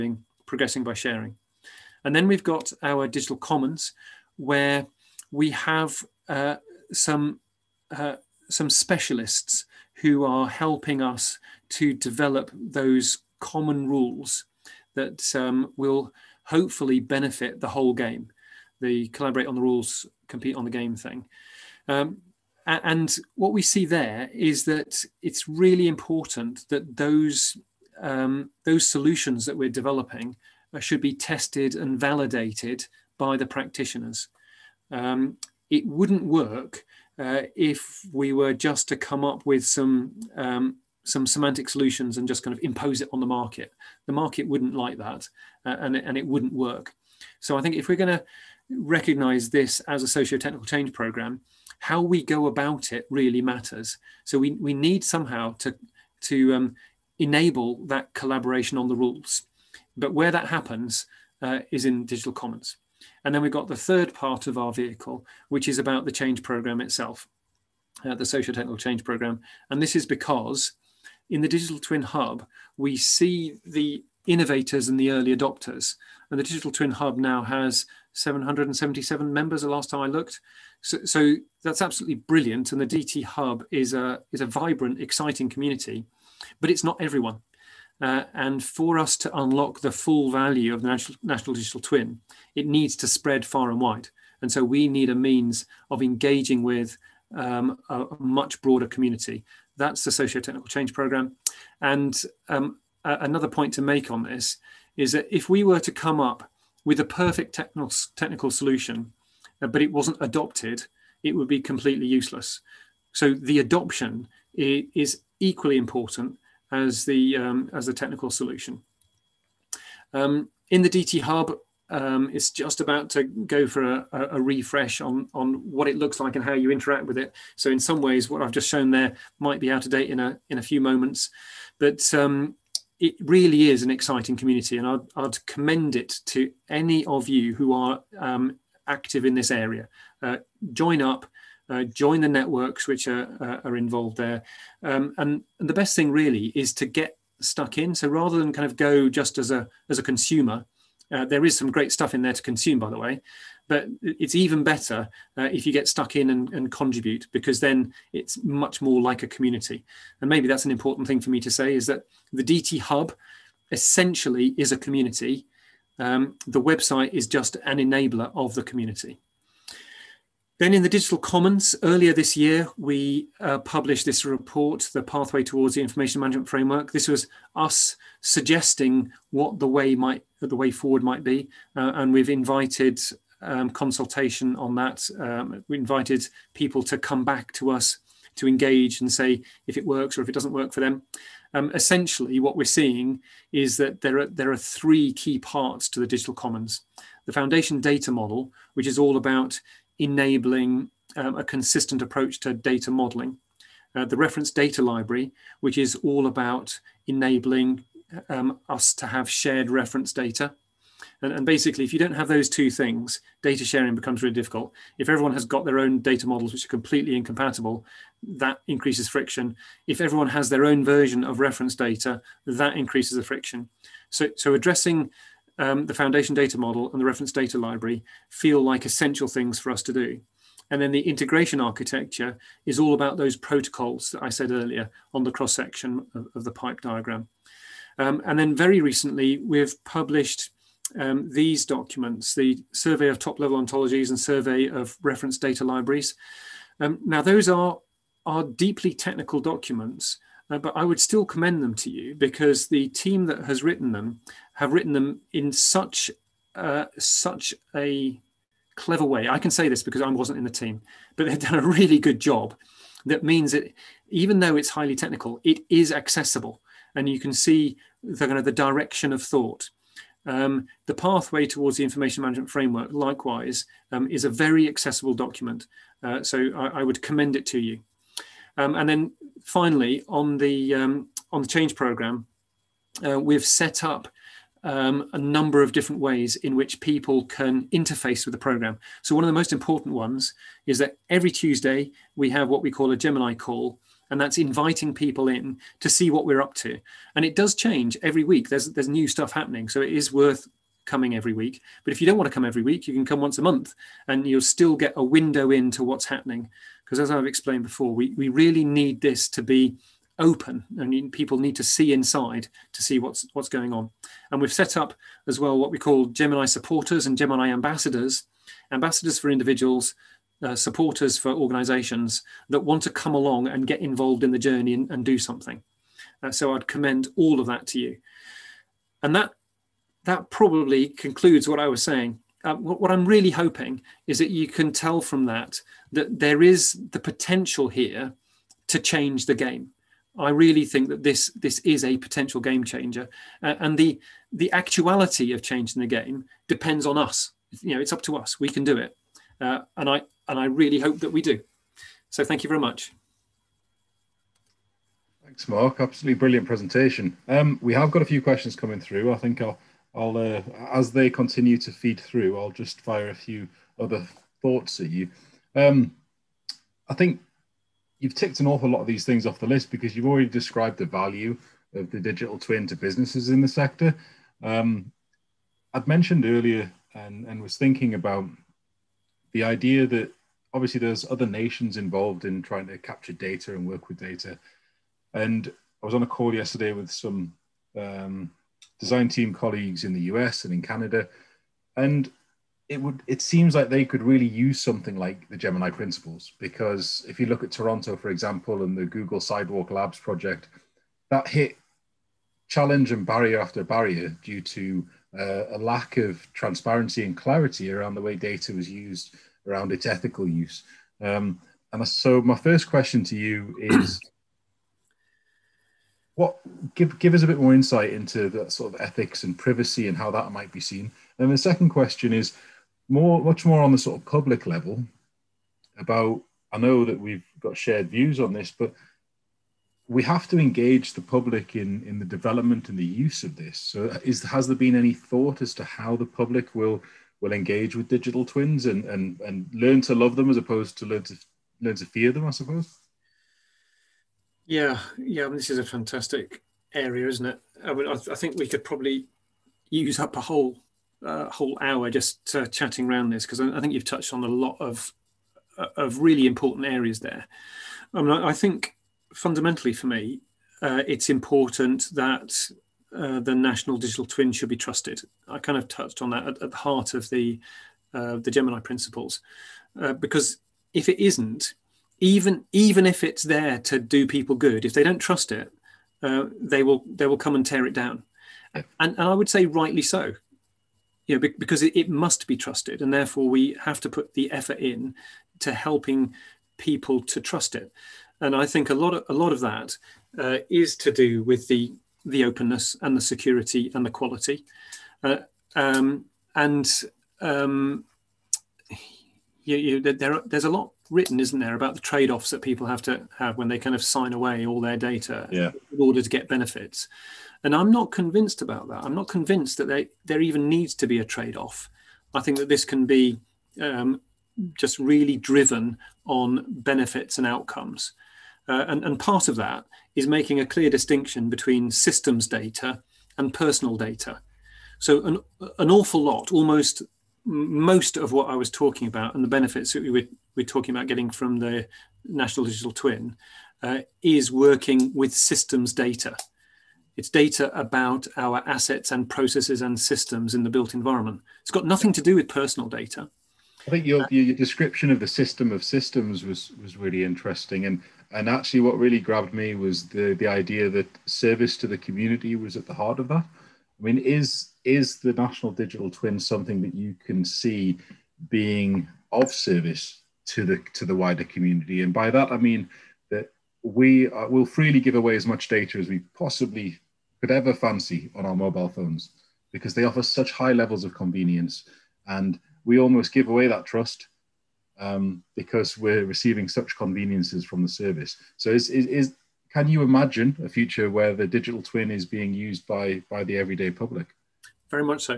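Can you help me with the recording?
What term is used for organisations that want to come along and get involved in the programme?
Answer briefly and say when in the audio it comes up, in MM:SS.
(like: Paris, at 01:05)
Gemini supporters, at 05:16.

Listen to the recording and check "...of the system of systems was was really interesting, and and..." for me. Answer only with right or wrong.
right.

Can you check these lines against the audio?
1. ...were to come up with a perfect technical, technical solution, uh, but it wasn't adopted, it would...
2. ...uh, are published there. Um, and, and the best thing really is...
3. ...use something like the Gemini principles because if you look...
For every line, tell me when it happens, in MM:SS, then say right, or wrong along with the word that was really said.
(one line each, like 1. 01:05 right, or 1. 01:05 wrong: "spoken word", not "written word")
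1. 01:45 right
2. 02:23 wrong: "involved", not "published"
3. 06:34 right.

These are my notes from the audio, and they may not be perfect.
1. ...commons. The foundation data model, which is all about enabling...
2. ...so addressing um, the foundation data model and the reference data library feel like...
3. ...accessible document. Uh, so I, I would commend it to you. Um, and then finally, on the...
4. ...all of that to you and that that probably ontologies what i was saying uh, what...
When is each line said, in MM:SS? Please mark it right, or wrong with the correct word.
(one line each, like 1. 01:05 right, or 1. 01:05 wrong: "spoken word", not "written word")
1. 03:16 right
2. 03:44 right
3. 04:34 right
4. 05:27 wrong: "concludes", not "ontologies".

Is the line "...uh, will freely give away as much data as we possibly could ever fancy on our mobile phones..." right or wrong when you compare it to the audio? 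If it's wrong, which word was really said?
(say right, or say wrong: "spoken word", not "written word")
right.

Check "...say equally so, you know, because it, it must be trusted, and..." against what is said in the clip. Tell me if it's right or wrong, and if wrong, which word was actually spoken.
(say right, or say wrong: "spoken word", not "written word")
wrong: "rightly", not "equally".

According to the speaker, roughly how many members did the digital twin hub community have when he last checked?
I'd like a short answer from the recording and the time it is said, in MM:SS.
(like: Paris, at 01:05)
777, at 01:18.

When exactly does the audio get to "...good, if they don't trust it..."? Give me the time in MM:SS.
07:54.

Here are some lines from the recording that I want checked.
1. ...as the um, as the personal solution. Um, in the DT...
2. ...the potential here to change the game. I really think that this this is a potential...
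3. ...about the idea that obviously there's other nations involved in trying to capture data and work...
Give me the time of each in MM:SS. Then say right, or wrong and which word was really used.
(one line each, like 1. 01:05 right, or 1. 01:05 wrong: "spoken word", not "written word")
1. 01:56 wrong: "technical", not "personal"
2. 05:36 right
3. 06:17 right.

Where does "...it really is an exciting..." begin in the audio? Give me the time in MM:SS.
02:12.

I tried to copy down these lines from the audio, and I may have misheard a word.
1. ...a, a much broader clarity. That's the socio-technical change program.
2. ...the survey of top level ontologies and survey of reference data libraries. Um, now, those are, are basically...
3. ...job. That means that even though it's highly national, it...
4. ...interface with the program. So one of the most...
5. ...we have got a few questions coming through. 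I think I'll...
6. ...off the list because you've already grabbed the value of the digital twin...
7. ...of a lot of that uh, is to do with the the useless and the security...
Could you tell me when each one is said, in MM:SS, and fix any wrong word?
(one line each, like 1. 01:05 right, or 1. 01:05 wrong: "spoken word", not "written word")
1. 01:37 wrong: "community", not "clarity"
2. 04:02 wrong: "deeply", not "basically"
3. 04:22 wrong: "technical", not "national"
4. 04:47 right
5. 05:57 right
6. 06:09 wrong: "described", not "grabbed"
7. 08:08 wrong: "openness", not "useless".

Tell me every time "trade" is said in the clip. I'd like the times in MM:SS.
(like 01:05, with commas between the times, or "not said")
08:21, 08:31.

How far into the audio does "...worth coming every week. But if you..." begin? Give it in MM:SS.
05:00.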